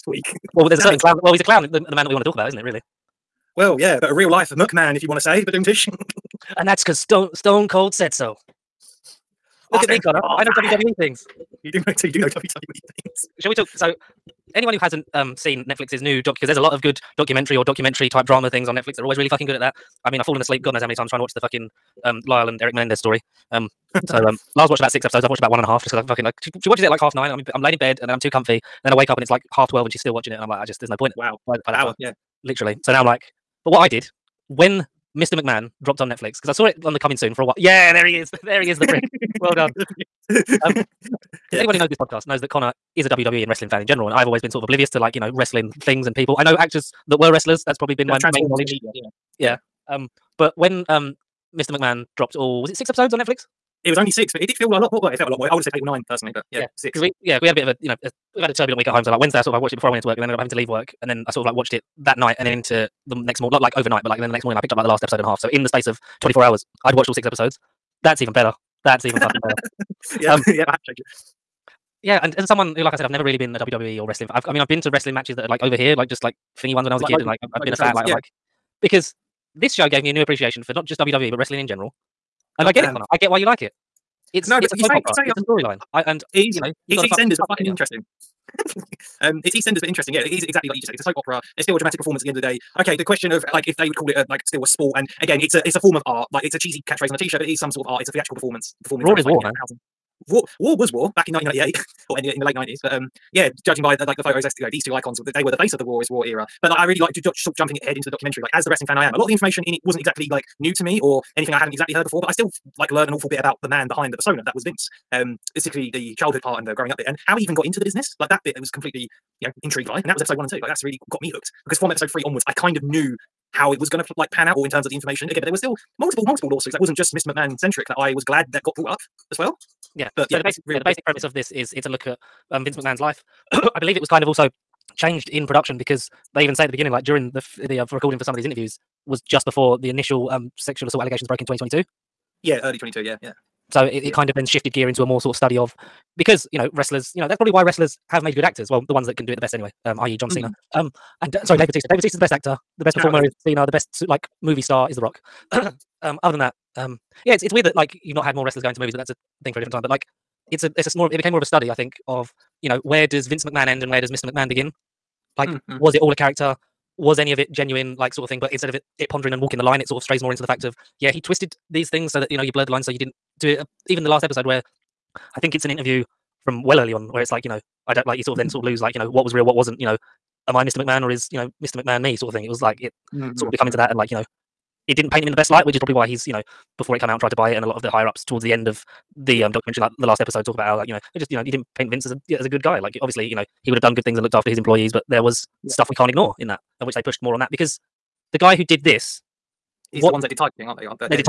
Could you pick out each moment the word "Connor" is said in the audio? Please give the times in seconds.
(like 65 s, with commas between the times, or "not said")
9 s, 42 s, 82 s.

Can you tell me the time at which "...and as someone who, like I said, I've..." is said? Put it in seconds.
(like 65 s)
72 s.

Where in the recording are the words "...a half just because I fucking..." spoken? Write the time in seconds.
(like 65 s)
25 s.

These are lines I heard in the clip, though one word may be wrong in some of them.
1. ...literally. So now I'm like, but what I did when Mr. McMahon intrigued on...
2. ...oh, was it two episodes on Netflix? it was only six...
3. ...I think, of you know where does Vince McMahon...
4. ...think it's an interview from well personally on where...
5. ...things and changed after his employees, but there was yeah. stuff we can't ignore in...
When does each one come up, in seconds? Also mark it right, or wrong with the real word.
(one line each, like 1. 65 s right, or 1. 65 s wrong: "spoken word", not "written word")
1. 32 s wrong: "dropped", not "intrigued"
2. 52 s wrong: "six", not "two"
3. 161 s right
4. 175 s wrong: "early", not "personally"
5. 194 s wrong: "looked", not "changed".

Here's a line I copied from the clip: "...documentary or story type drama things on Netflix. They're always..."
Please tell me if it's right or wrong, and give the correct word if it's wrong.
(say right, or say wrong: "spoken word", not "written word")
wrong: "documentary", not "story".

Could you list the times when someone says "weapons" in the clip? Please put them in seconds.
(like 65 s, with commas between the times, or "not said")
not said.